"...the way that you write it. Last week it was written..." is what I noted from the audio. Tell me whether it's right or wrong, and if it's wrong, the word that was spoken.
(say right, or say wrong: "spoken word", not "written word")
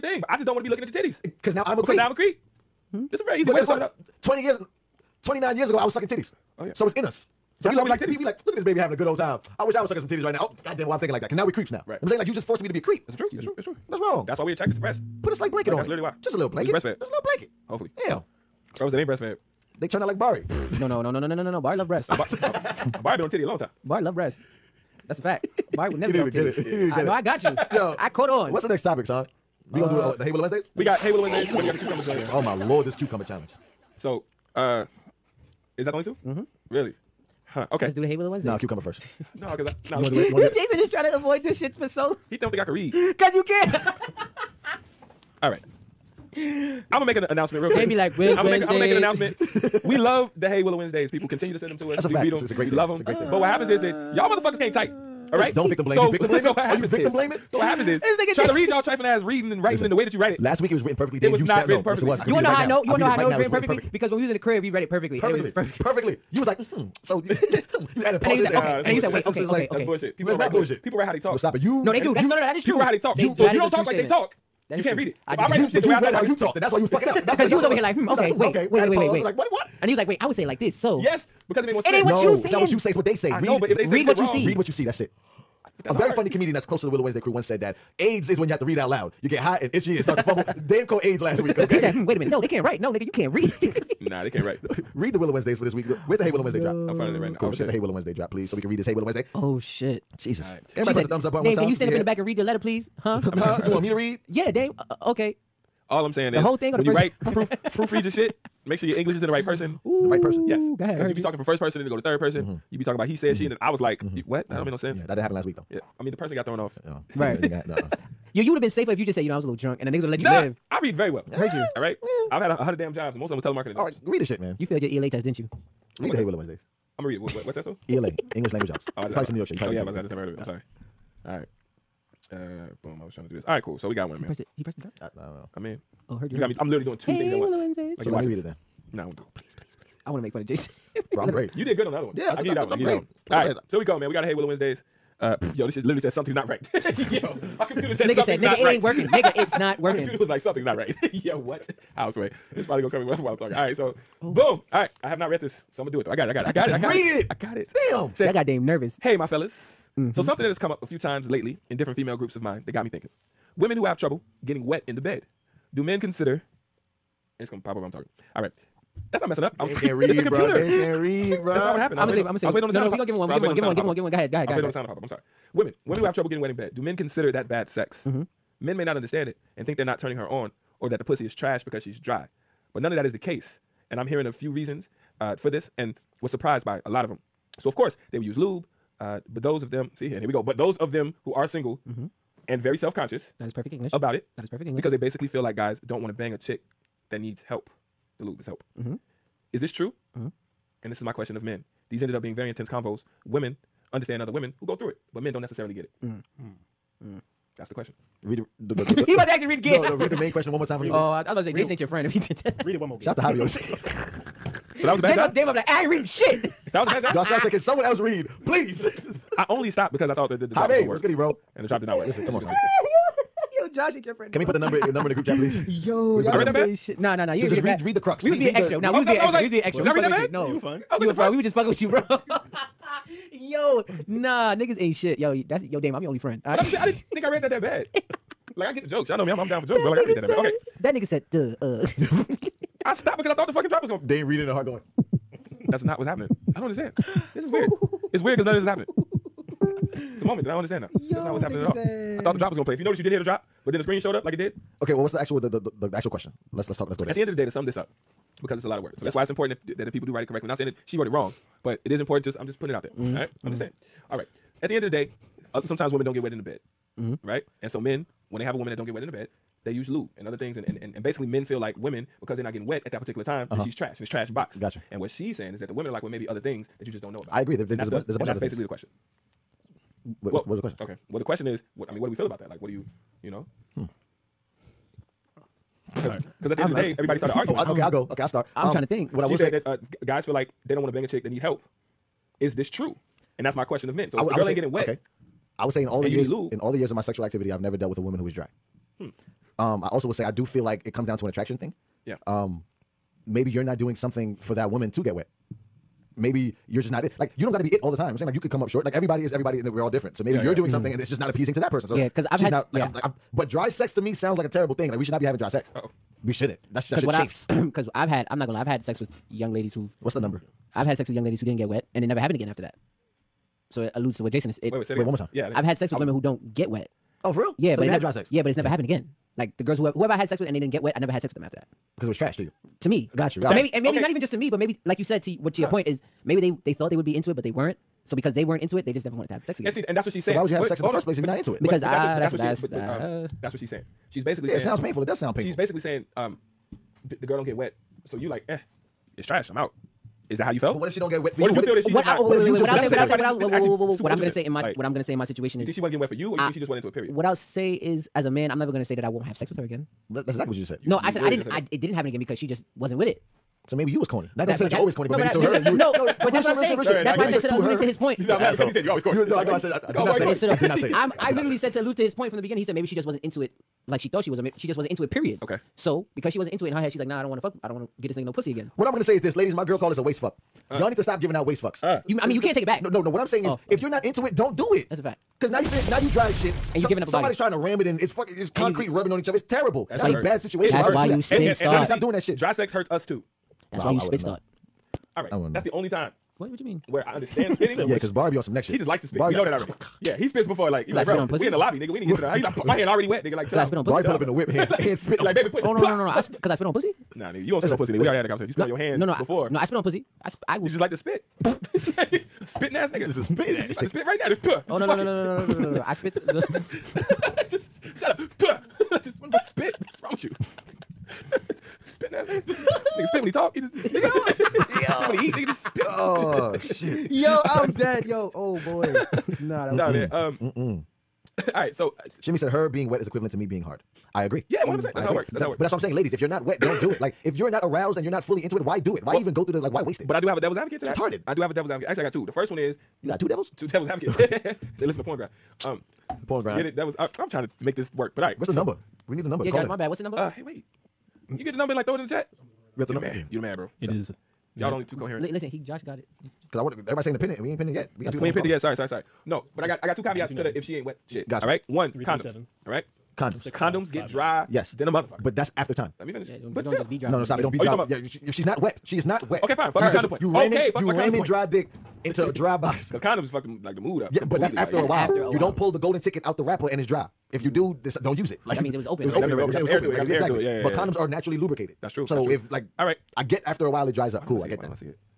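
right.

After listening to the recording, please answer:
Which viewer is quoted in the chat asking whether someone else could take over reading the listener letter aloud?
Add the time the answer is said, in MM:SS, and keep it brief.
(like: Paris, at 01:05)
Darcel, at 03:37.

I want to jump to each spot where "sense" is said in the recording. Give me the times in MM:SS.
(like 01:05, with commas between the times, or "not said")
01:21, 01:54.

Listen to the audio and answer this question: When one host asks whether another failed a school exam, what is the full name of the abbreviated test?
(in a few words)
English language arts.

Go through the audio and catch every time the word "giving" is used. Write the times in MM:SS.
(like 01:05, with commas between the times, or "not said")
06:21, 06:26.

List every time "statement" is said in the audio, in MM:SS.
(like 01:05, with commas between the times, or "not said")
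01:13.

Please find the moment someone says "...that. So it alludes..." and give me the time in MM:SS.
05:22.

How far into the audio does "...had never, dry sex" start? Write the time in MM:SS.
05:27.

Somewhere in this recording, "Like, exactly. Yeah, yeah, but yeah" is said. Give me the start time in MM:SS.
07:59.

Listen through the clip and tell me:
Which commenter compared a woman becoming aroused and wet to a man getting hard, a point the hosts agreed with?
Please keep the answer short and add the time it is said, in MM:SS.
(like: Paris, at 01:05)
Shimmy, at 07:12.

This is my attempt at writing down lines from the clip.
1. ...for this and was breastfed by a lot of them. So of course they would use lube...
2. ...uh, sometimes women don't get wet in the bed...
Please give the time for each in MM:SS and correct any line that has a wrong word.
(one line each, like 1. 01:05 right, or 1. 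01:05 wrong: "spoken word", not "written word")
1. 03:05 wrong: "surprised", not "breastfed"
2. 04:25 right.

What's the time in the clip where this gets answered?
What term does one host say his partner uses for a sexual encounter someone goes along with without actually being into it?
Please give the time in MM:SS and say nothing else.
06:20.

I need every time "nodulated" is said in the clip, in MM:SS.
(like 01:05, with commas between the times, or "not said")
not said.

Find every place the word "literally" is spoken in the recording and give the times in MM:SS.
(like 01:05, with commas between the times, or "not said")
00:15, 02:16, 02:25, 06:11.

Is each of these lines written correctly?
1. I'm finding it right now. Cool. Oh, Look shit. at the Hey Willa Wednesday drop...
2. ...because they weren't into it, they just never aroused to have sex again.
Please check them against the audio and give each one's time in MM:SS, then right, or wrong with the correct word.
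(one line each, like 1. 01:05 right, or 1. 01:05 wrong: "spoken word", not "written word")
1. 01:36 right
2. 05:38 wrong: "wanted", not "aroused".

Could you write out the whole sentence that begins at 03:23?
Women understand other women who go through it, but men don't necessarily get it.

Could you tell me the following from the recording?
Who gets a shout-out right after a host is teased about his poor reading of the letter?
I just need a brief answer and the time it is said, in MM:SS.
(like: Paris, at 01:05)
Javier, at 03:33.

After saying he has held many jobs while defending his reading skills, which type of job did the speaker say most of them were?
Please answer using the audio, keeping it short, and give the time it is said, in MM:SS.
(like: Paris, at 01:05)
Telemarketing, at 02:03.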